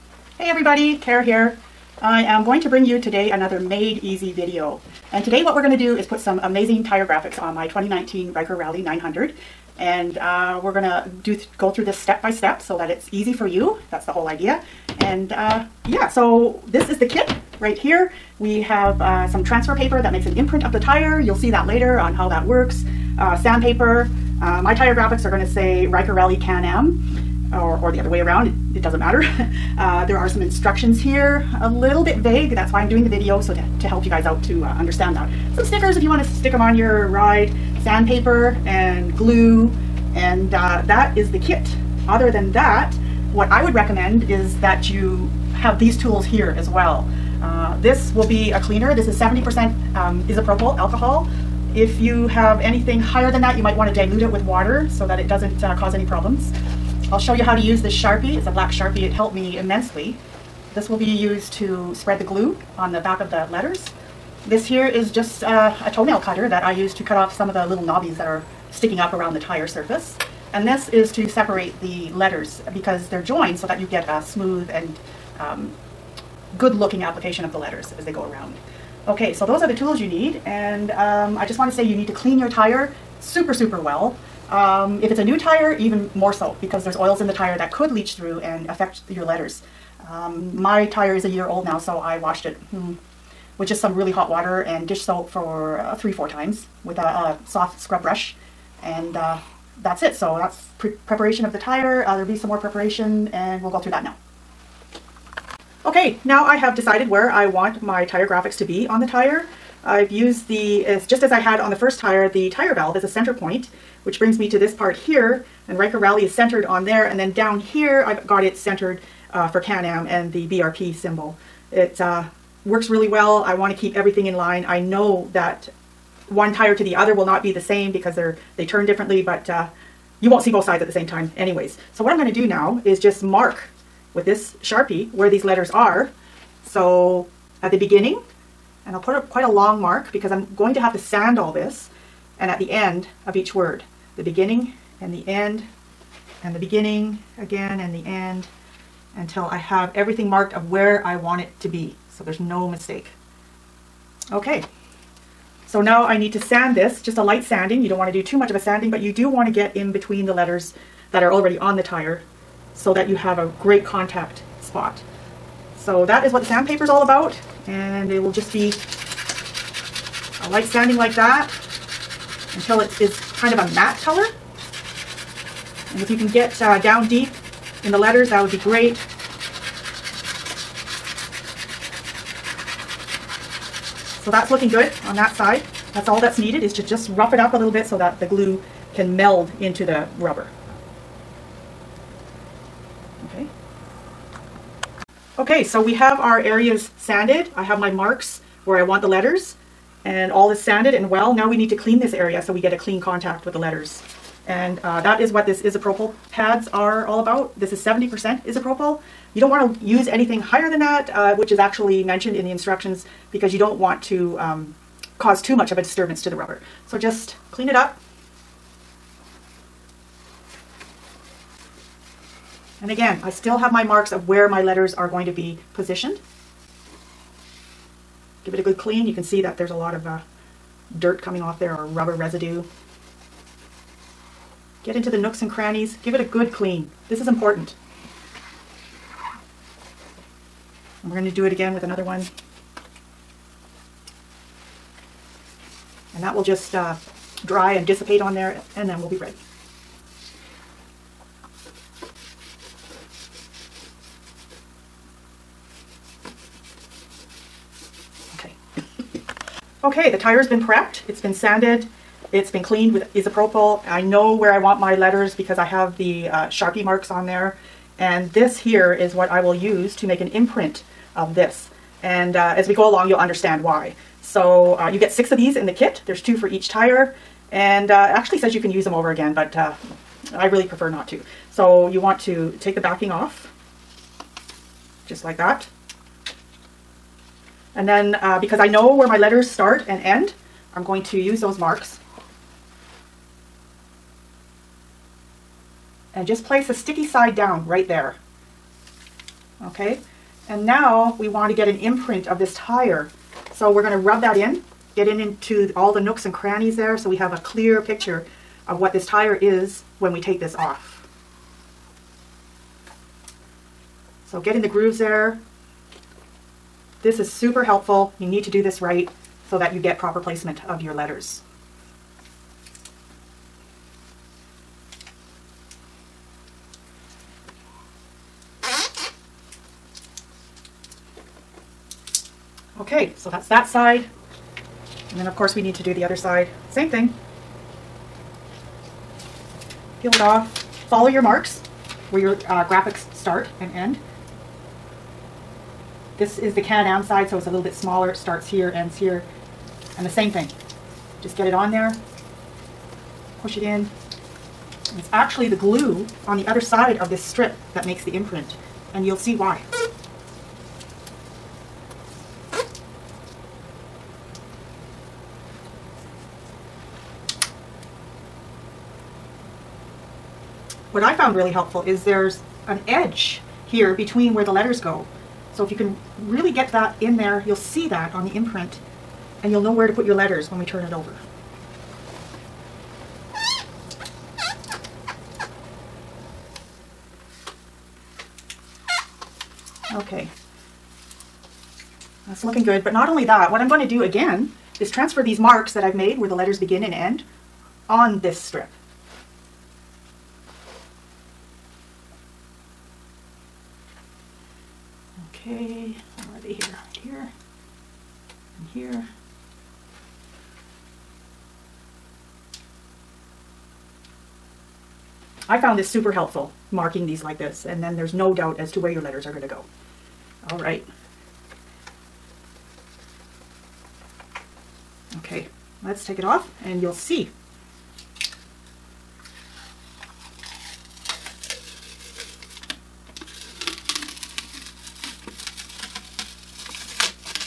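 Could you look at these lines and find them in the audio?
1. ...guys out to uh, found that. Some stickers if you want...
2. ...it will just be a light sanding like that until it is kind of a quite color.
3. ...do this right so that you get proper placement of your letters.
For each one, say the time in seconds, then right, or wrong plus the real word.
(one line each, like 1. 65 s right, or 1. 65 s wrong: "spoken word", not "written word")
1. 34 s wrong: "understand", not "found"
2. 168 s wrong: "matte", not "quite"
3. 318 s right.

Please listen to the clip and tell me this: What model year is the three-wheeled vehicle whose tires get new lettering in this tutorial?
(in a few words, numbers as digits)
2019.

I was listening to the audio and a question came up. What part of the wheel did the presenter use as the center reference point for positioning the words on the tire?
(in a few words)
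tire valve.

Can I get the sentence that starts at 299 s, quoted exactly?
Okay, and now we want to get an imprint of this tire.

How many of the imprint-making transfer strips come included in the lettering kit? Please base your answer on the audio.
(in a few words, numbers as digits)
6.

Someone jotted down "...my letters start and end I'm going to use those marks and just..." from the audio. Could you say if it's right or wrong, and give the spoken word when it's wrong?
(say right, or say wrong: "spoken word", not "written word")
right.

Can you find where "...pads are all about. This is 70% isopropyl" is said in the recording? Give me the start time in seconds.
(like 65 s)
206 s.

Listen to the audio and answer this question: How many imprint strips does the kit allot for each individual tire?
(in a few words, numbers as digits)
2.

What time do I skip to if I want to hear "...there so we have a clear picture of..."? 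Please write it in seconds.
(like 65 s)
306 s.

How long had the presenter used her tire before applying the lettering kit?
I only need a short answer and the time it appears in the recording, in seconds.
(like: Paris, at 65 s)
a year, at 91 s.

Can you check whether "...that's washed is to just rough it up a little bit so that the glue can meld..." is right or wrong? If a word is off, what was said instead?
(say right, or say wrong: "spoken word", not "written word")
wrong: "needed", not "washed".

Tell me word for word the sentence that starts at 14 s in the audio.
And uh, yeah, so this is the kit right here.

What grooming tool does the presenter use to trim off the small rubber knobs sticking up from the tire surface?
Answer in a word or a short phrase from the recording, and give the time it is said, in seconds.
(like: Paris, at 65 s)
toenail cutter, at 65 s.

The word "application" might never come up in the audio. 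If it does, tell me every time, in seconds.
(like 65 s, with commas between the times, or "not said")
77 s.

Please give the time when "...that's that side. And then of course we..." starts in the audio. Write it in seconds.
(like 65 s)
333 s.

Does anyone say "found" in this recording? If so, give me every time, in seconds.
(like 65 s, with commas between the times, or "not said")
371 s, 415 s.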